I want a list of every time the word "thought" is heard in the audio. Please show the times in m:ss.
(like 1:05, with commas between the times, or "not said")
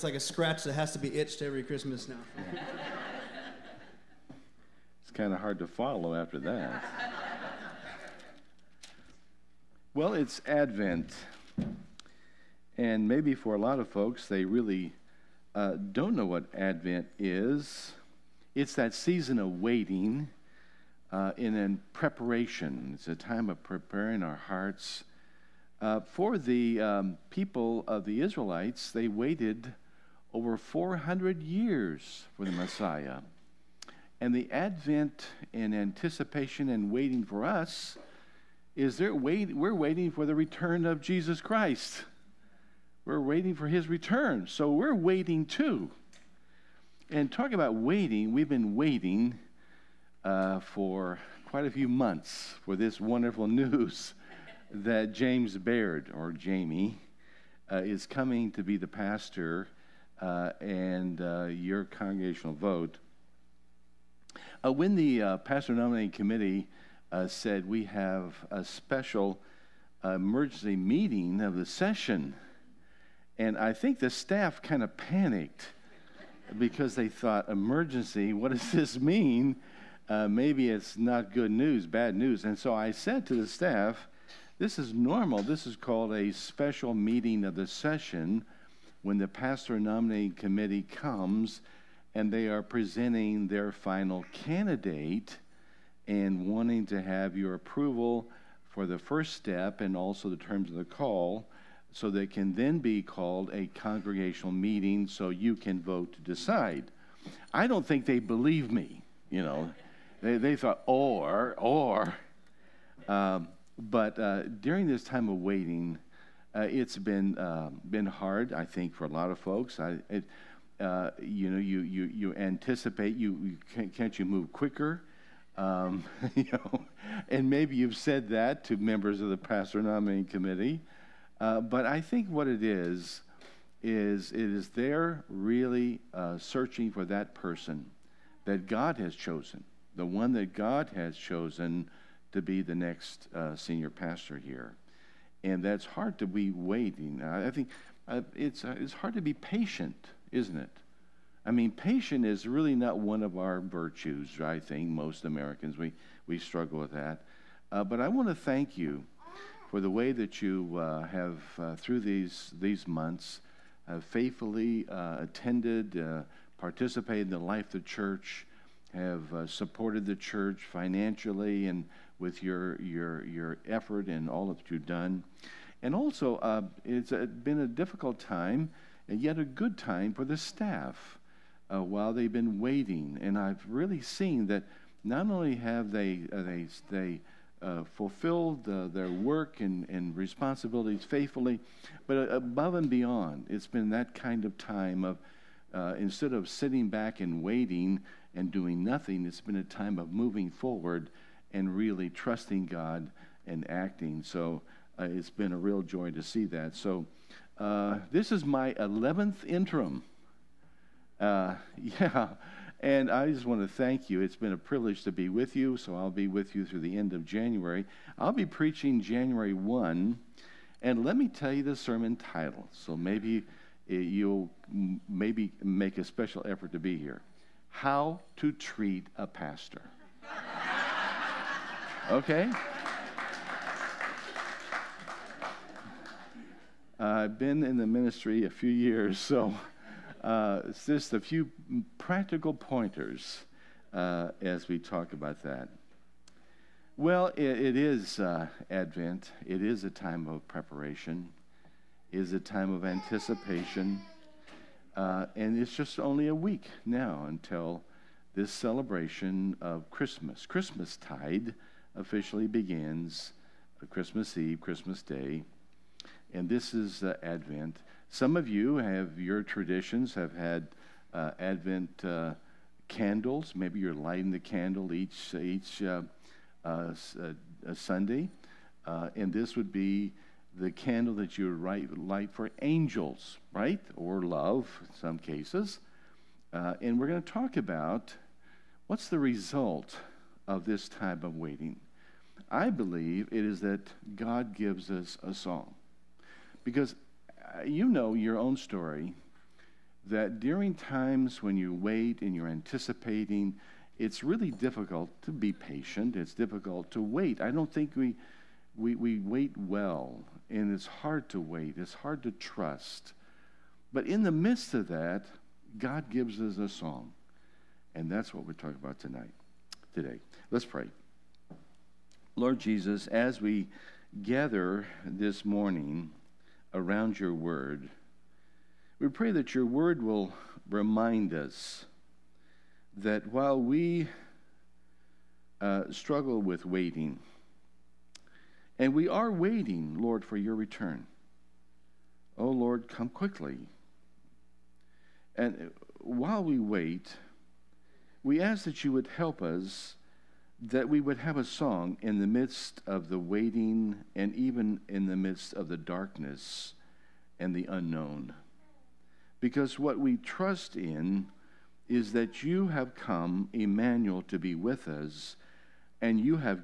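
1:17, 1:50.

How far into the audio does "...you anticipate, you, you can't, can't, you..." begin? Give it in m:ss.
2:02.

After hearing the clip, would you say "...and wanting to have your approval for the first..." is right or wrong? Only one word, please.
right.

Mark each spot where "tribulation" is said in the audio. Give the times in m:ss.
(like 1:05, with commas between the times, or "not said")
not said.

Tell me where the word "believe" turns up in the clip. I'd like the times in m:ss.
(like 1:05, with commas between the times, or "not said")
1:48, 4:52.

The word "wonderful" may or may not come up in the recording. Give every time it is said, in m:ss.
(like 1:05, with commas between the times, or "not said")
0:52.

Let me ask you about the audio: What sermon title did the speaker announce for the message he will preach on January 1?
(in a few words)
How to treat a pastor.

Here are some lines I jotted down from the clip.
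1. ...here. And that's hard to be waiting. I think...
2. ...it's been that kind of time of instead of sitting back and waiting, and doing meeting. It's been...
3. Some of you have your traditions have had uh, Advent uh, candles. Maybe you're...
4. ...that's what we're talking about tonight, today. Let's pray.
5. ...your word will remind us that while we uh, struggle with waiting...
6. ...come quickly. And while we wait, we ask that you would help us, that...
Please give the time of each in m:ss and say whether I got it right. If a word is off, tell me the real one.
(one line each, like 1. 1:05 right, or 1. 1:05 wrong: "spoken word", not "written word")
1. 2:24 right
2. 3:13 wrong: "nothing", not "meeting"
3. 4:28 right
4. 5:18 right
5. 5:29 right
6. 5:42 right.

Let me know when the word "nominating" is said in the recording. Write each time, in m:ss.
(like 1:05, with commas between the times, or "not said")
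1:05, 1:29, 2:09.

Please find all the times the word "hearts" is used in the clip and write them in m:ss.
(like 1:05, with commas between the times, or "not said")
0:24.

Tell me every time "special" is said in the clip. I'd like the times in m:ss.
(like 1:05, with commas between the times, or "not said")
1:08, 1:26, 3:46.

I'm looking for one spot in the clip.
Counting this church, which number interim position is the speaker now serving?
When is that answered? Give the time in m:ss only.
3:28.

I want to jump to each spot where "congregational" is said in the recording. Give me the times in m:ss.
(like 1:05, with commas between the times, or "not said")
1:01, 1:43.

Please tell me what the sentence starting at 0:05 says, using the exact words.
it's kind of hard to follow after that.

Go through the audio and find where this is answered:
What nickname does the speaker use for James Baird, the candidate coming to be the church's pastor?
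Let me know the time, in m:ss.
0:56.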